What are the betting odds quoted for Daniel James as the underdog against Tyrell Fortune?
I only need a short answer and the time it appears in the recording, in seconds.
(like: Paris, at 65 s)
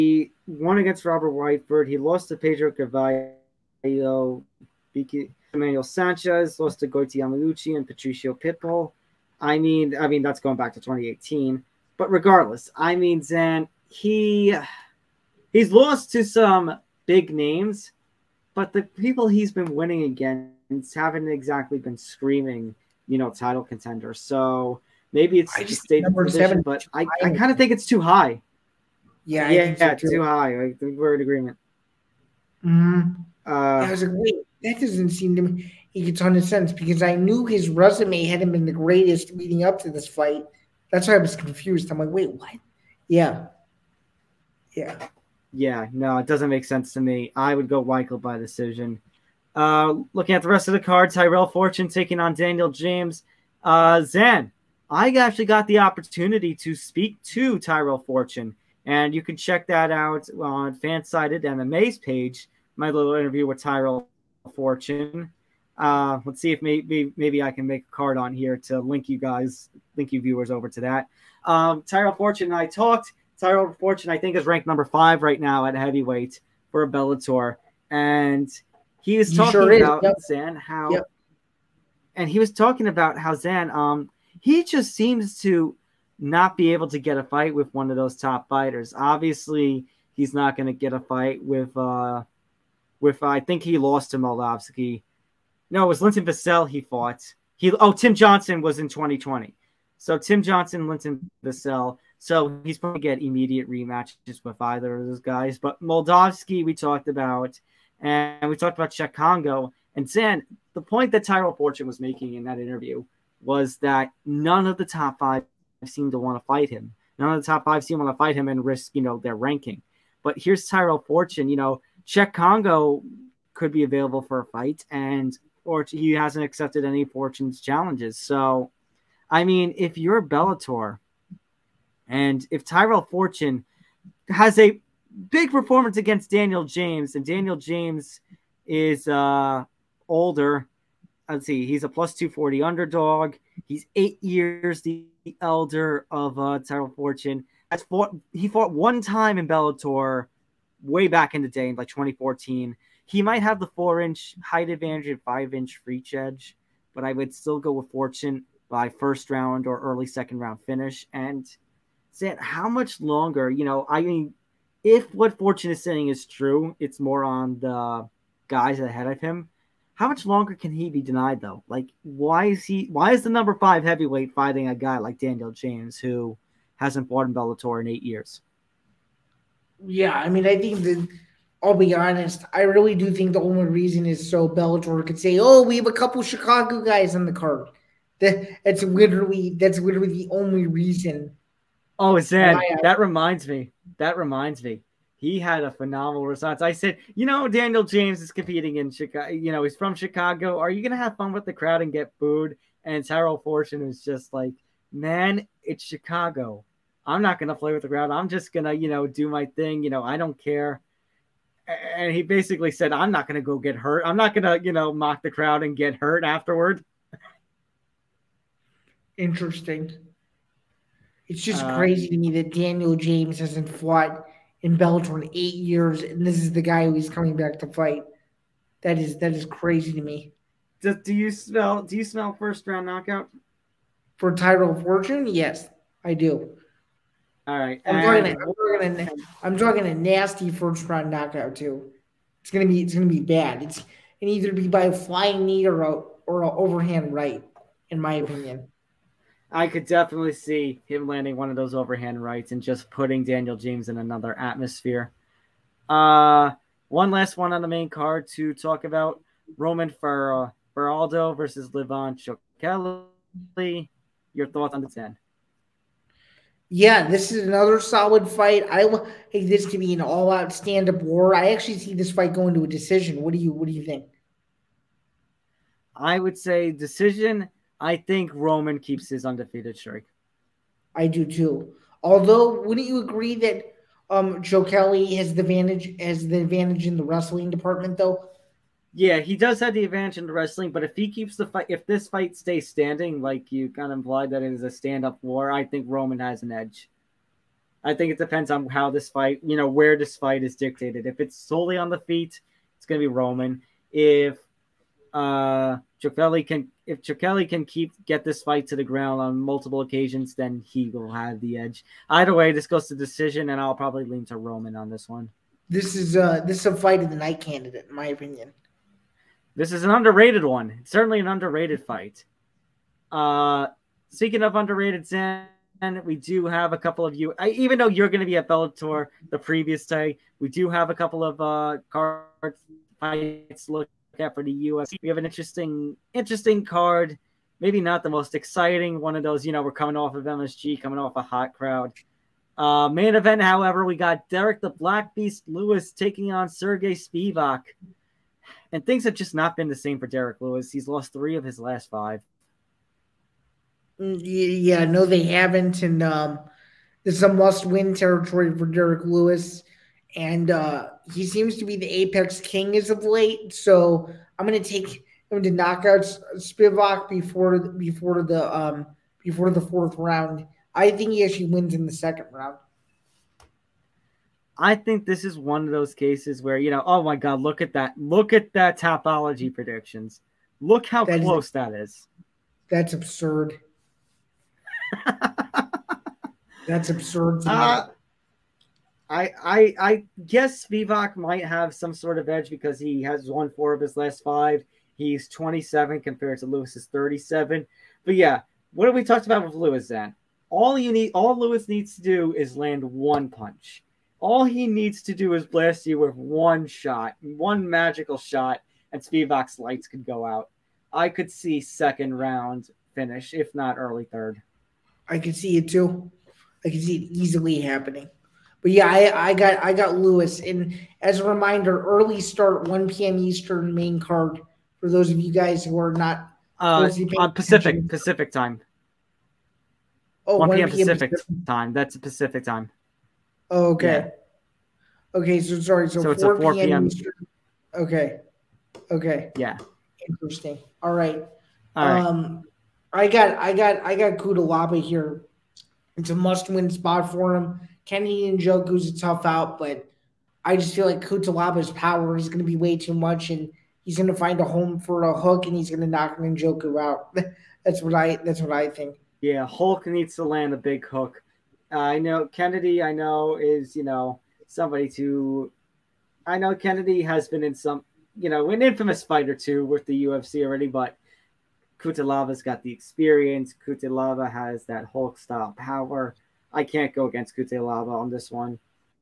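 +240, at 141 s.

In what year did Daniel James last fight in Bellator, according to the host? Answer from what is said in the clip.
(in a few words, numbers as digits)
2014.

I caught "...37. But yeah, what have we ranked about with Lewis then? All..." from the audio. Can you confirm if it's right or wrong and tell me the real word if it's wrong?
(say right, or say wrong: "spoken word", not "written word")
wrong: "talked", not "ranked".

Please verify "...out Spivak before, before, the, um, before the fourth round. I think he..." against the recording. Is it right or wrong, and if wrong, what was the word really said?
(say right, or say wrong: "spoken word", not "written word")
right.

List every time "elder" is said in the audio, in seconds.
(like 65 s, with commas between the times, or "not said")
145 s.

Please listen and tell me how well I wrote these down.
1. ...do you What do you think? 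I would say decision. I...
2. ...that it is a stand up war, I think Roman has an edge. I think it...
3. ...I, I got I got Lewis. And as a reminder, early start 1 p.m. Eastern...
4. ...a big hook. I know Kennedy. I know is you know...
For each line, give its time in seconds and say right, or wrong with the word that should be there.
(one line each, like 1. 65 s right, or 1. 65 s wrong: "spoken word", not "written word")
1. 273 s right
2. 294 s right
3. 418 s right
4. 460 s right.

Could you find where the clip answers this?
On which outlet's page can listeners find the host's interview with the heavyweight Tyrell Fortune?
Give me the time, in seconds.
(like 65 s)
60 s.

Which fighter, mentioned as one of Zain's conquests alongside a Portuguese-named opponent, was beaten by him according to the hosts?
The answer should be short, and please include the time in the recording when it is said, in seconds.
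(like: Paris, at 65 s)
Robert Whiteford, at 1 s.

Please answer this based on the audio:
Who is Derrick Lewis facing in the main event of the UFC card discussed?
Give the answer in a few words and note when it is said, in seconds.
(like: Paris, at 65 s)
Sergey Spivak, at 346 s.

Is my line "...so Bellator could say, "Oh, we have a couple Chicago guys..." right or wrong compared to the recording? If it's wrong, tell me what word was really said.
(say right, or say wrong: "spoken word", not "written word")
right.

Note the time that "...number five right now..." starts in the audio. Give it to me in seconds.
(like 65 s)
74 s.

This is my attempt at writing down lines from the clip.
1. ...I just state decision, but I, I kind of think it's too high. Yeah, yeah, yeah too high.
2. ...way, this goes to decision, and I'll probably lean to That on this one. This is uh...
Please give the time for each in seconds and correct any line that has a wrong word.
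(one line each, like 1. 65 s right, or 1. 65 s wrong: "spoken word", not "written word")
1. 25 s wrong: "position", not "decision"
2. 312 s wrong: "Roman", not "That".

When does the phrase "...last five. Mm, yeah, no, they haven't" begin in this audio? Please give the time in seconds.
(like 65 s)
351 s.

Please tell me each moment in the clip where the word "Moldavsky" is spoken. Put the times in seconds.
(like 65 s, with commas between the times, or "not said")
94 s, 105 s.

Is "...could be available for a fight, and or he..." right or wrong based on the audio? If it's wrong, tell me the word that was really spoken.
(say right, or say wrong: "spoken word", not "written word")
right.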